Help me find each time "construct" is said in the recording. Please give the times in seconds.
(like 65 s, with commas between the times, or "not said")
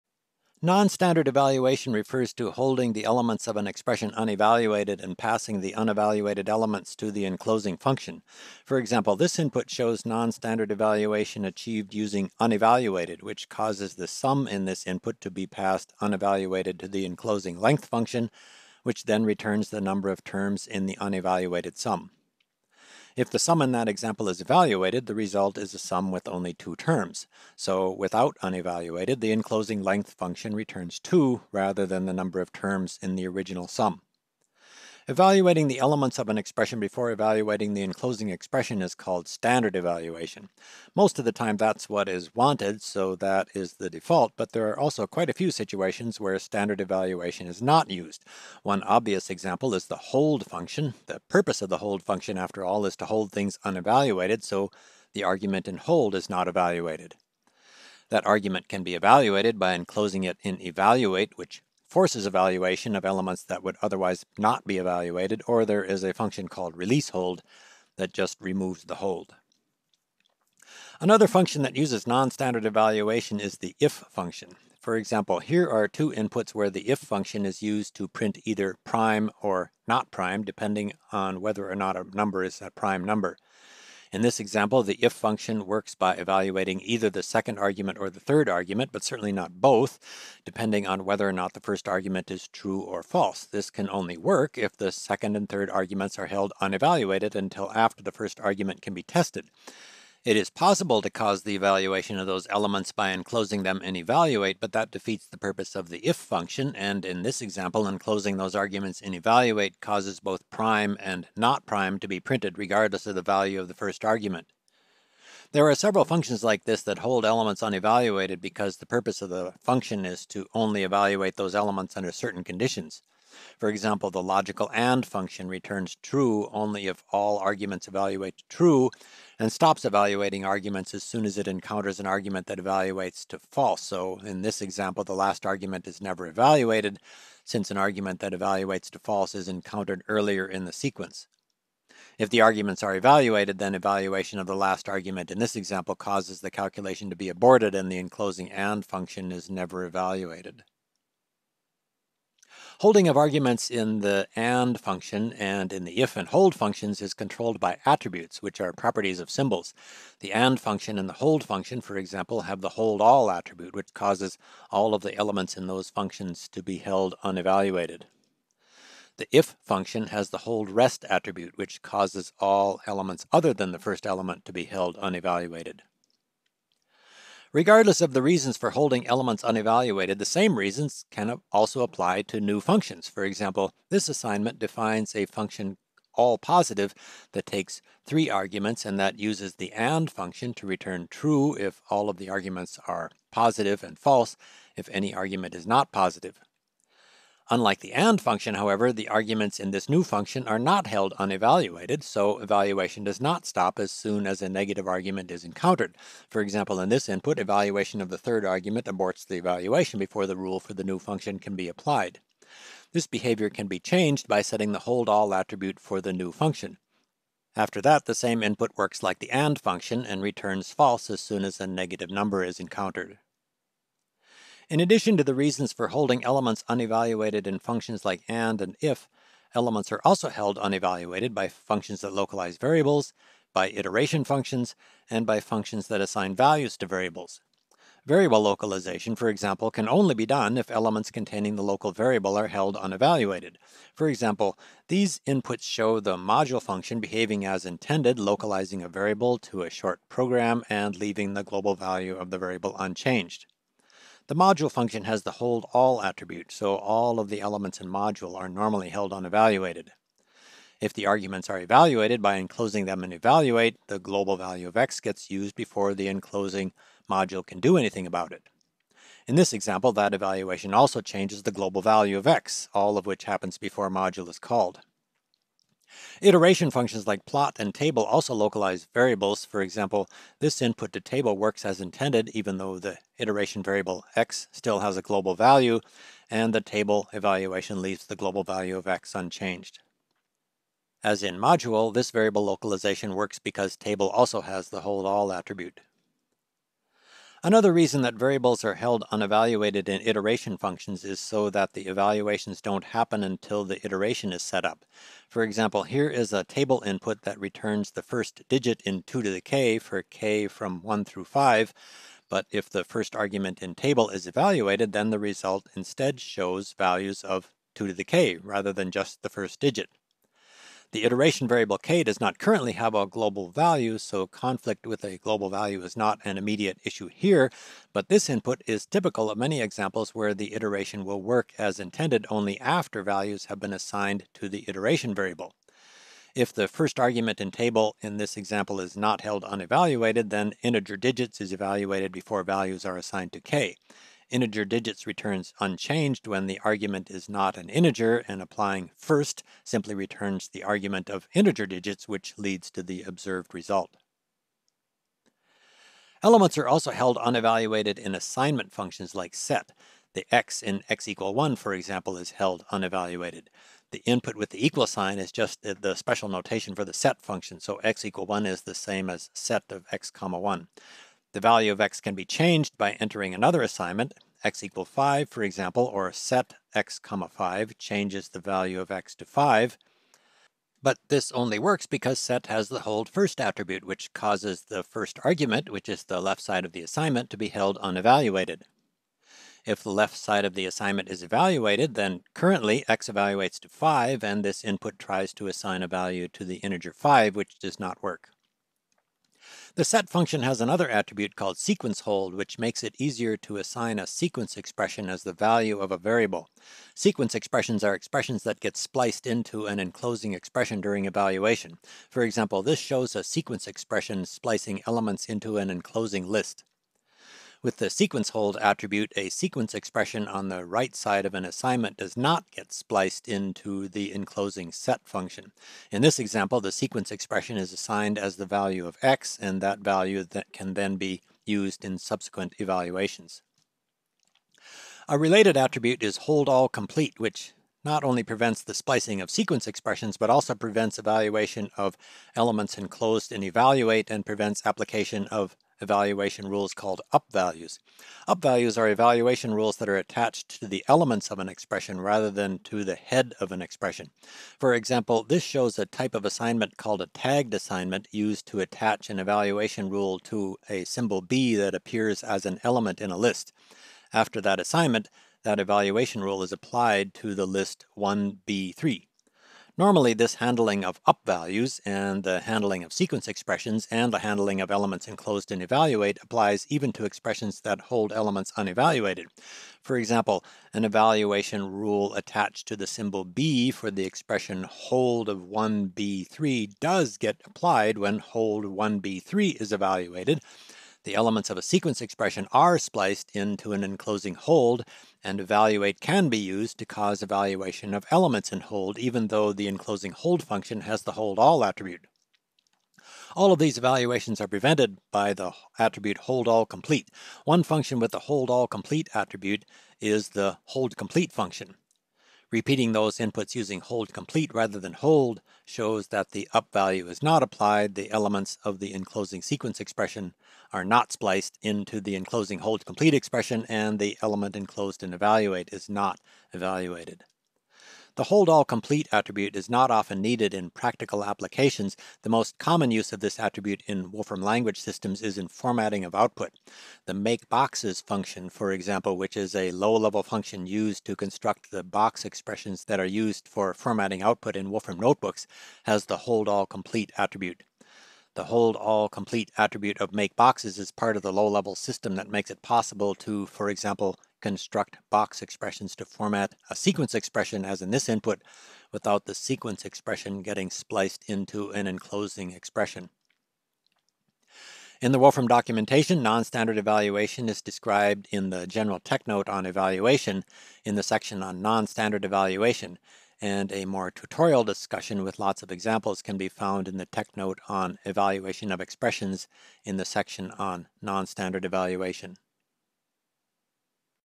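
541 s, 554 s.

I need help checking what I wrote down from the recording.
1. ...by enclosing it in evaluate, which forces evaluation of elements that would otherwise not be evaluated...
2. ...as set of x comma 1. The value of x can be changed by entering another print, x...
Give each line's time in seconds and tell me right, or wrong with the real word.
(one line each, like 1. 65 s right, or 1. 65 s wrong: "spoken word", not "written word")
1. 59 s right
2. 369 s wrong: "assignment", not "print".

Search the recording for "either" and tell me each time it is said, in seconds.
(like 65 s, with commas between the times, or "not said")
78 s, 86 s.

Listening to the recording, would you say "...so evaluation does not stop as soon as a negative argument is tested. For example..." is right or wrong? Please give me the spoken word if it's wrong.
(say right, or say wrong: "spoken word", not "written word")
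wrong: "encountered", not "tested".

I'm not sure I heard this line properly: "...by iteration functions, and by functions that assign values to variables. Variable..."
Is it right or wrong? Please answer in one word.
right.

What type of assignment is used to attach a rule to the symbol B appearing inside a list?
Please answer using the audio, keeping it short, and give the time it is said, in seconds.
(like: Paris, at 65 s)
tagged assignment, at 457 s.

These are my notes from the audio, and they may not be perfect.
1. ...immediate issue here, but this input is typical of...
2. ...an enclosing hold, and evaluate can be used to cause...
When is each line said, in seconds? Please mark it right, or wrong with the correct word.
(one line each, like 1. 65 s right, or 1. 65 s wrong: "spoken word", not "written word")
1. 326 s right
2. 493 s right.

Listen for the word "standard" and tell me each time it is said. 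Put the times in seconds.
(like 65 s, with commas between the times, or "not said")
0 s, 10 s, 39 s, 46 s, 72 s, 566 s, 571 s, 581 s.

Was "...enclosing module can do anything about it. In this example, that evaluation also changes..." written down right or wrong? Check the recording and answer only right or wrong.
right.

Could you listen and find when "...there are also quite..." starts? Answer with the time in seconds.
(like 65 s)
44 s.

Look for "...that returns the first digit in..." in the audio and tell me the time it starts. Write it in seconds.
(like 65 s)
307 s.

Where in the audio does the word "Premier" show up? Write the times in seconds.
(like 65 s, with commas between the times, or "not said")
not said.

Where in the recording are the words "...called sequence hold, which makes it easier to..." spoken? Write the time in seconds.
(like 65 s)
401 s.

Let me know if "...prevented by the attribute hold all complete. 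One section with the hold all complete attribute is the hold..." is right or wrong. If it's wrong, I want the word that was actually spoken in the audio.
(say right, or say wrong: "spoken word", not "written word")
wrong: "function", not "section".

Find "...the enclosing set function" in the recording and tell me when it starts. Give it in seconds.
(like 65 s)
423 s.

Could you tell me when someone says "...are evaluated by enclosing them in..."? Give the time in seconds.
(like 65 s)
261 s.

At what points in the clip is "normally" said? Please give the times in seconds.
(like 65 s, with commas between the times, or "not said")
258 s, 469 s.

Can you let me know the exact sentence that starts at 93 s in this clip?
This can only work if the second and third arguments are held unevaluated until after the first argument can be tested.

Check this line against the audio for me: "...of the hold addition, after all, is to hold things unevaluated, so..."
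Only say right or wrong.
wrong.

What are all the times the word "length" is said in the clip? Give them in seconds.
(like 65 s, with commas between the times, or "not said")
17 s, 29 s.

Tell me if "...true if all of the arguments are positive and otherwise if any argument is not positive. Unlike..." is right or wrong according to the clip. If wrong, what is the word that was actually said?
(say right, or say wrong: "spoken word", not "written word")
wrong: "false", not "otherwise".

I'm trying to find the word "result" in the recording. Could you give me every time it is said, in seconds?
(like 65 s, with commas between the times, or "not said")
25 s, 315 s, 353 s.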